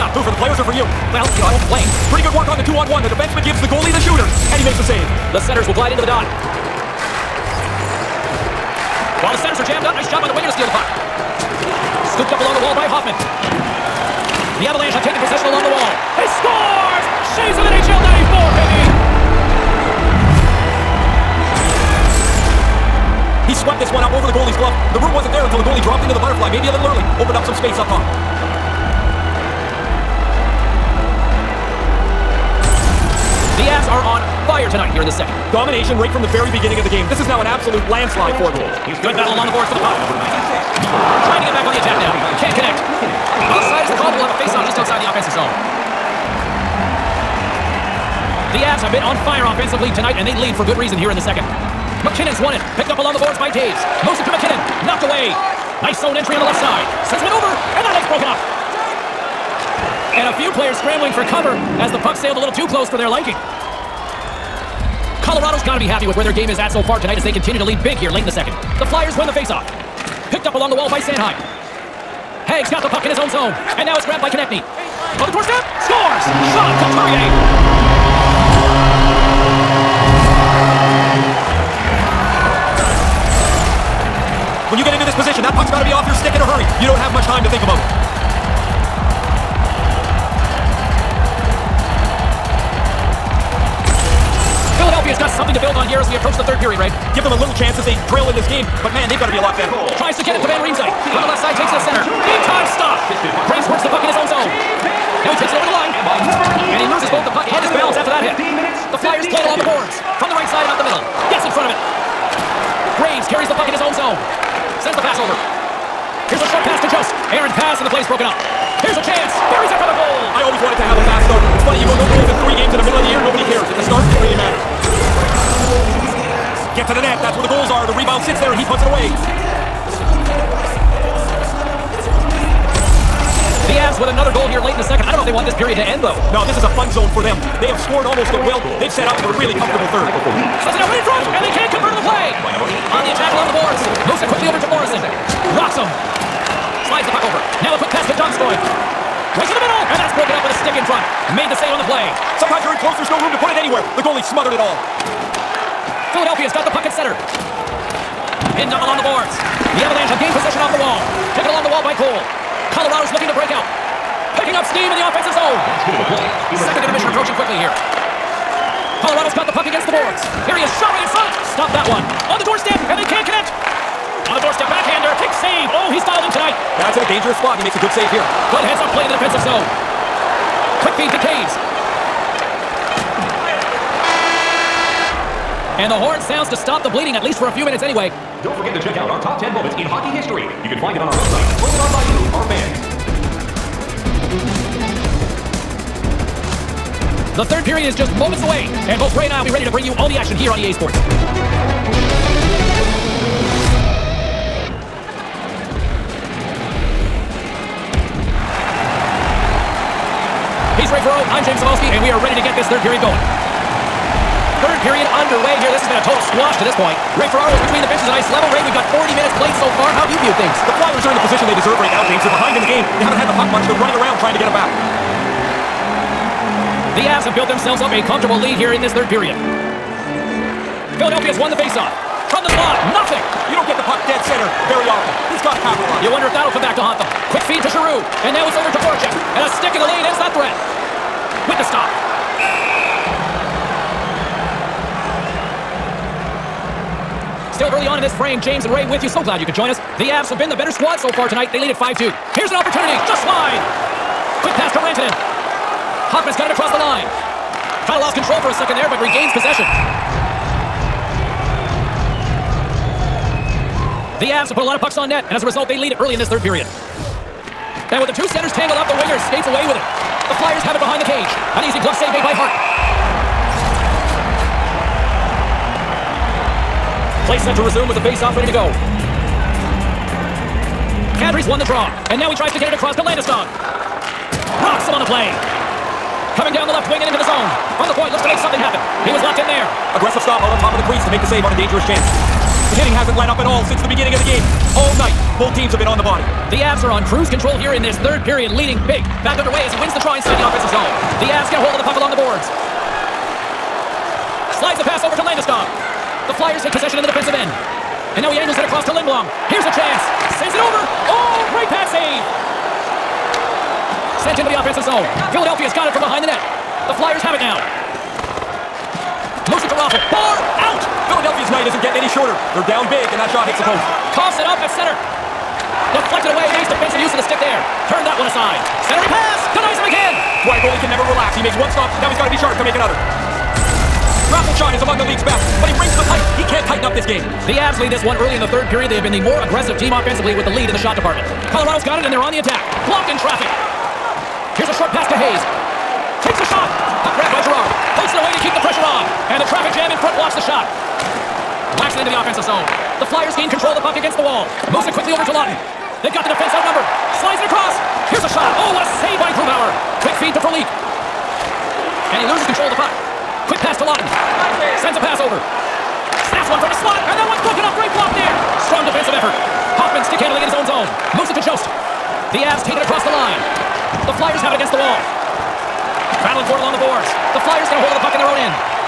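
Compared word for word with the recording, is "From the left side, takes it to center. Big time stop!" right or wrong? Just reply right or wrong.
right.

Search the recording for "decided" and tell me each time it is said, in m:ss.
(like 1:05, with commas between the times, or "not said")
not said.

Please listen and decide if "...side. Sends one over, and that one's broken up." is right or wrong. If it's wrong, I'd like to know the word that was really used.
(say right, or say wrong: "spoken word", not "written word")
right.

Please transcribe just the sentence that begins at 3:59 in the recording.
And a stick in the lane ends that threat.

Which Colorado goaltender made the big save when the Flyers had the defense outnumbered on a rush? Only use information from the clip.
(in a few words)
Grubauer.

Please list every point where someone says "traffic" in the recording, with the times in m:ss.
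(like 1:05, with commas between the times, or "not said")
5:43, 5:49.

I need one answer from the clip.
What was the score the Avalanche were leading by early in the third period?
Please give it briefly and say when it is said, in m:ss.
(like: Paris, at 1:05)
5-2, at 4:11.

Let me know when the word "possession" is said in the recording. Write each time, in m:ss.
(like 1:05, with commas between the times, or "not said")
0:15, 2:40, 4:19, 5:06.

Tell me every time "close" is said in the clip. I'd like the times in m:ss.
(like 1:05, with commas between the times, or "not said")
1:02, 2:32.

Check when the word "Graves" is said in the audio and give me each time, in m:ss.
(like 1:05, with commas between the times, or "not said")
1:43, 1:52.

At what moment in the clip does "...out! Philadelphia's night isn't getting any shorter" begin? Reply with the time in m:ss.
5:20.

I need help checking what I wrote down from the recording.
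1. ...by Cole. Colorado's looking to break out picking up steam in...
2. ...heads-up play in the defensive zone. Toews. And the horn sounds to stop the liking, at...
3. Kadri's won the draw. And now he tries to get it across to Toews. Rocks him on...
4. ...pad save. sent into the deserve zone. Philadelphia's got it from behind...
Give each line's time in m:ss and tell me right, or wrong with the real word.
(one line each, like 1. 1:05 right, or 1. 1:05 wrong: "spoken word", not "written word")
1. 2:41 right
2. 2:58 wrong: "bleeding", not "liking"
3. 4:41 wrong: "Landeskog", not "Toews"
4. 5:11 wrong: "offensive", not "deserve".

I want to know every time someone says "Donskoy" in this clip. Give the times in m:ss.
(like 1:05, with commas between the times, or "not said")
2:28.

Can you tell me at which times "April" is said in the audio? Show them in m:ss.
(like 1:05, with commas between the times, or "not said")
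not said.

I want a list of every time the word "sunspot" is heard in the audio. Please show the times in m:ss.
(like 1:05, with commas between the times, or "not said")
not said.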